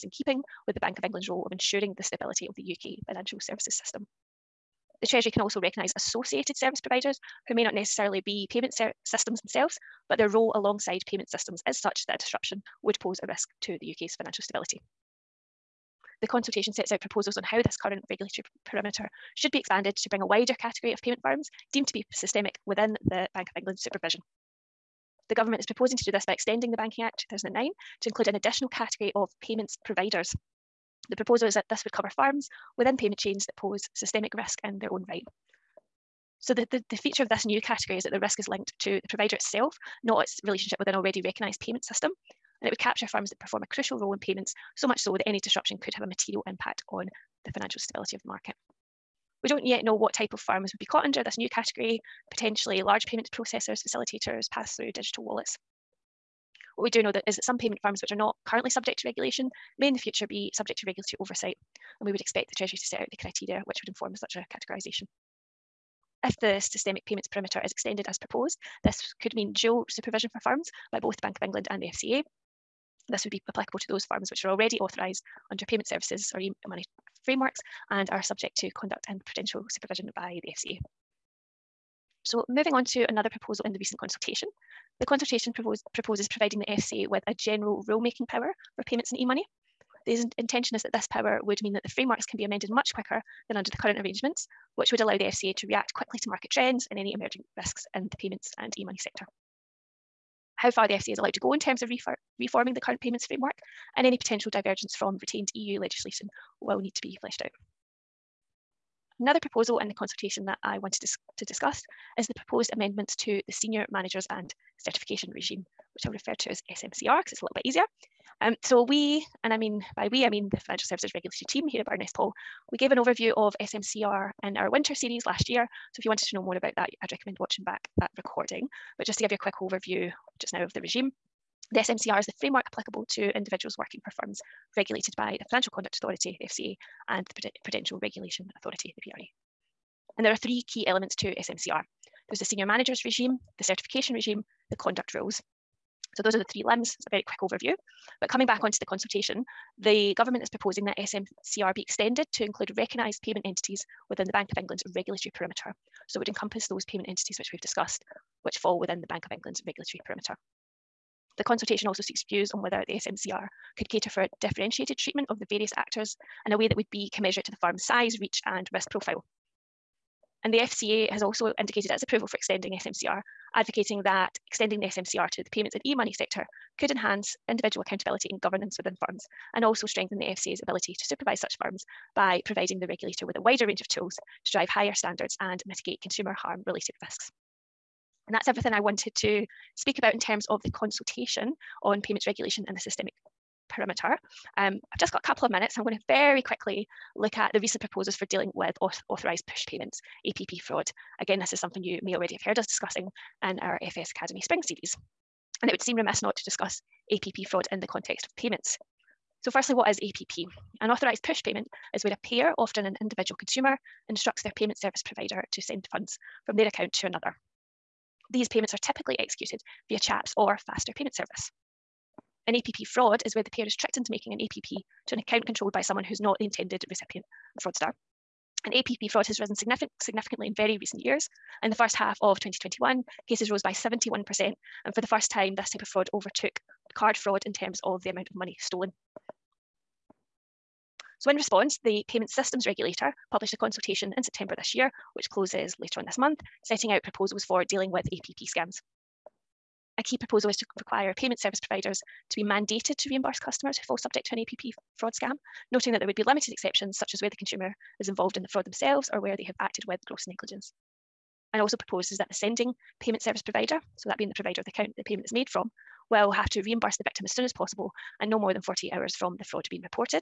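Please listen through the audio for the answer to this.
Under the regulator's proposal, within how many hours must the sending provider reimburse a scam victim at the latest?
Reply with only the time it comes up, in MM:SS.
04:28.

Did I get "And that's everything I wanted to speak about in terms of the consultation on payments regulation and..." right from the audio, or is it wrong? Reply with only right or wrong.
right.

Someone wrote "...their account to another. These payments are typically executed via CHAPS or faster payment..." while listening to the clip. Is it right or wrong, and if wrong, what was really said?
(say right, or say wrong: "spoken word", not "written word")
right.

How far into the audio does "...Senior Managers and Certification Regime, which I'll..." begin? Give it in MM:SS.
01:53.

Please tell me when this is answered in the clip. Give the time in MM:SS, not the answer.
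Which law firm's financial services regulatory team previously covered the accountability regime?
02:01.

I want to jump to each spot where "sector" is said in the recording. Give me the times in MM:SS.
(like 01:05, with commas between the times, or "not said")
01:38, 02:56.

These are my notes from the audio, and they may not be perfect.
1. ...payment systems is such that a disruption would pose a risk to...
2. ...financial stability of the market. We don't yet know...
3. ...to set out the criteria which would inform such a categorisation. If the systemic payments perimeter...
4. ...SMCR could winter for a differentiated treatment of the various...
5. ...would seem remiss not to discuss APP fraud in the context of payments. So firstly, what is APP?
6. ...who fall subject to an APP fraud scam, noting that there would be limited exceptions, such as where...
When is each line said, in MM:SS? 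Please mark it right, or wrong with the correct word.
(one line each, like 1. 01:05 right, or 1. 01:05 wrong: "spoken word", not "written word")
1. 00:11 right
2. 00:47 right
3. 01:02 right
4. 02:42 wrong: "cater", not "winter"
5. 03:25 right
6. 04:13 right.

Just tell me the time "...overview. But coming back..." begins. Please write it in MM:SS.
02:27.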